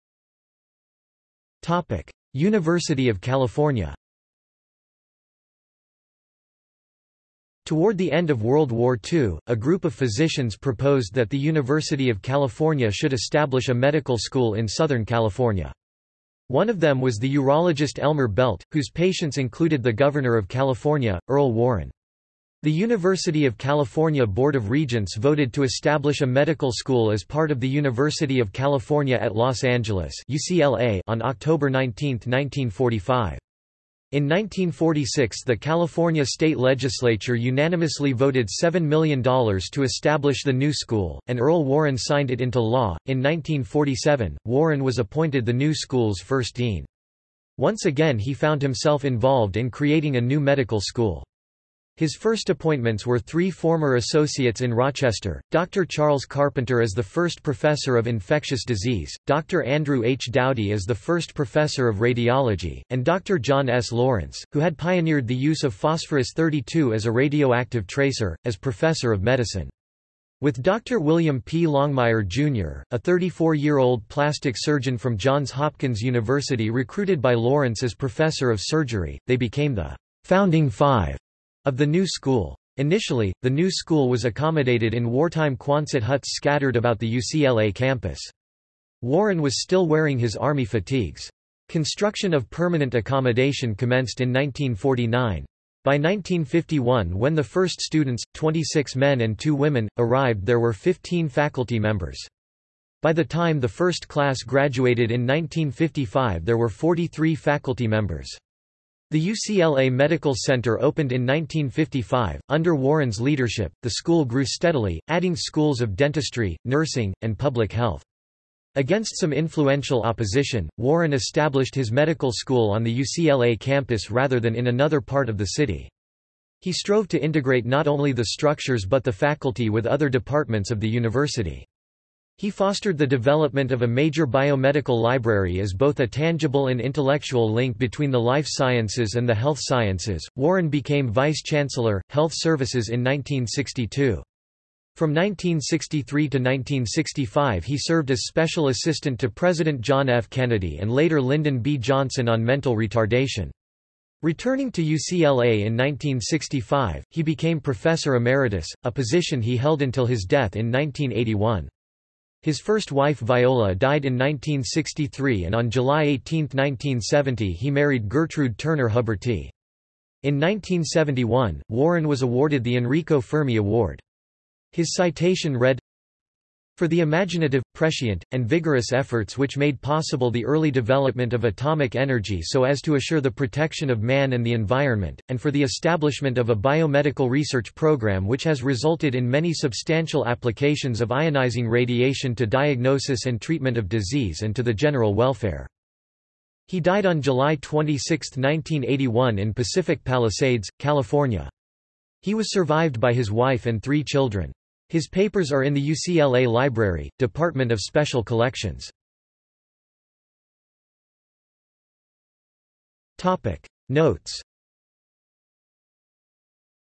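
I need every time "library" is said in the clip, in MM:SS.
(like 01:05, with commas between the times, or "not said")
02:15, 03:26.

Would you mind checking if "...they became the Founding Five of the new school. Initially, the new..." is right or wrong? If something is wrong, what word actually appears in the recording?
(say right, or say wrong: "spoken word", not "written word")
right.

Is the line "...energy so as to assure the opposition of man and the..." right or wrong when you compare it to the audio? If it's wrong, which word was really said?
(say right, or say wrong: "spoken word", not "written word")
wrong: "protection", not "opposition".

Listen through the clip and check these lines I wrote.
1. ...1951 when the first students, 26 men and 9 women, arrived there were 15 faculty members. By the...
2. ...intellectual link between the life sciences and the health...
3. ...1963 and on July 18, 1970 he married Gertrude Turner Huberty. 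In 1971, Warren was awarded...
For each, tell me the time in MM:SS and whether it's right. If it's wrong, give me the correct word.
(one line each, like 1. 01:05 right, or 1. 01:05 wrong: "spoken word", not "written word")
1. 01:35 wrong: "2", not "9"
2. 02:16 right
3. 02:44 right.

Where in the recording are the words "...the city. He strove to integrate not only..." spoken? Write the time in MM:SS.
02:05.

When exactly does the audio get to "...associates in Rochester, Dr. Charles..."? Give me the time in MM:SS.
00:53.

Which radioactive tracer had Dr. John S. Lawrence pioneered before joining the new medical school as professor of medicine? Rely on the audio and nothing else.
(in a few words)
phosphorus-32.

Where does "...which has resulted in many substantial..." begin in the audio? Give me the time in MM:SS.
03:08.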